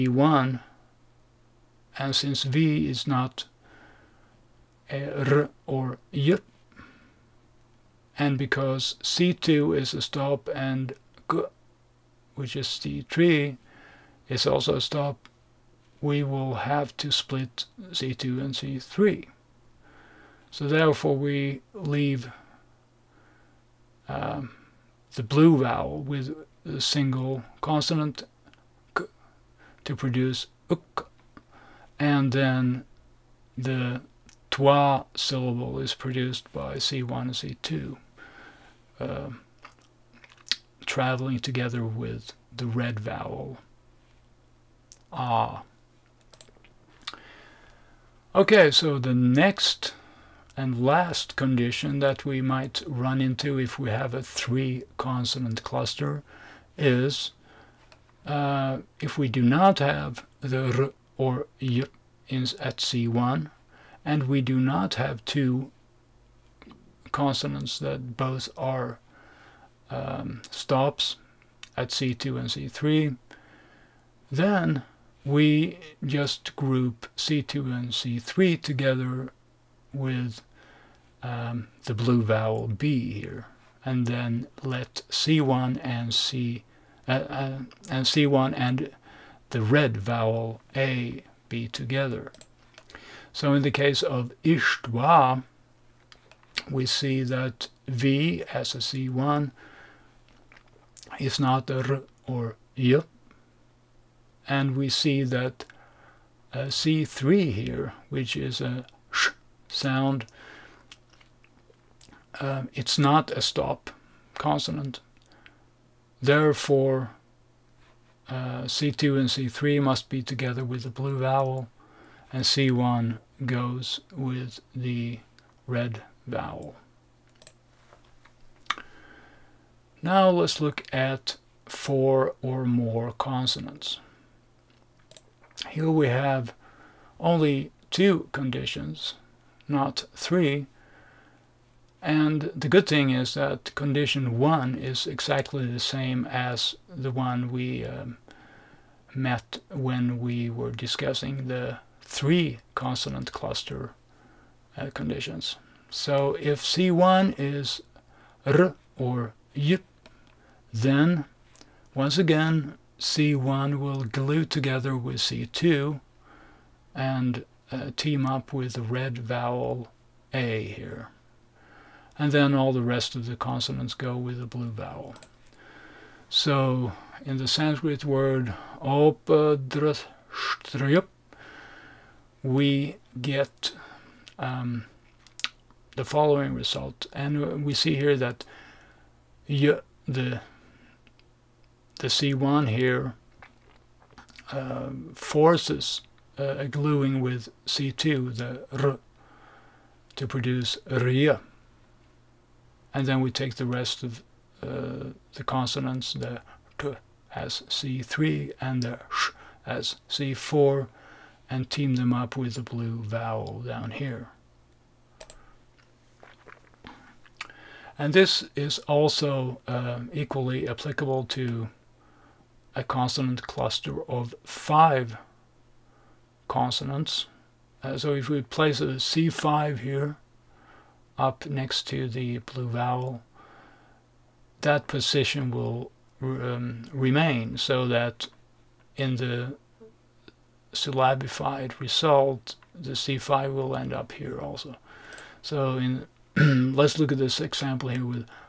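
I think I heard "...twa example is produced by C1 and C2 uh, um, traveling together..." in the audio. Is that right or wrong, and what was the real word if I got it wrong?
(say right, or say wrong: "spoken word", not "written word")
wrong: "syllable", not "example".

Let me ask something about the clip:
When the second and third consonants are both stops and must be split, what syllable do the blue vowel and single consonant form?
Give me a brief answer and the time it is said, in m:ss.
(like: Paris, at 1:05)
uk, at 0:30.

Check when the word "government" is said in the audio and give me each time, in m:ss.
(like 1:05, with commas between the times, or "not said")
not said.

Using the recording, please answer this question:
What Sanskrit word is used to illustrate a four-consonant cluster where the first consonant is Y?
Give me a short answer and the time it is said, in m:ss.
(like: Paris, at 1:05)
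opadrashtryup, at 2:58.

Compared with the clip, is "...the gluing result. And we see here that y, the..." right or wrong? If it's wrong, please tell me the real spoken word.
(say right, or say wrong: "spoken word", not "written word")
wrong: "following", not "gluing".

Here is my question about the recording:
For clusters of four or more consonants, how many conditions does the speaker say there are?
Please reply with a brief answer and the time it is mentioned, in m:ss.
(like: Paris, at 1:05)
2, at 2:17.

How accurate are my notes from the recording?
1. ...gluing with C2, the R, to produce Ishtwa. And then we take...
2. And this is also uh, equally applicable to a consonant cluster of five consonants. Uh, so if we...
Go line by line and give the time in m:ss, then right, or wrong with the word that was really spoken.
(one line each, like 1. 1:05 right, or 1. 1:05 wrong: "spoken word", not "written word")
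1. 3:16 wrong: "RIA", not "Ishtwa"
2. 3:37 right.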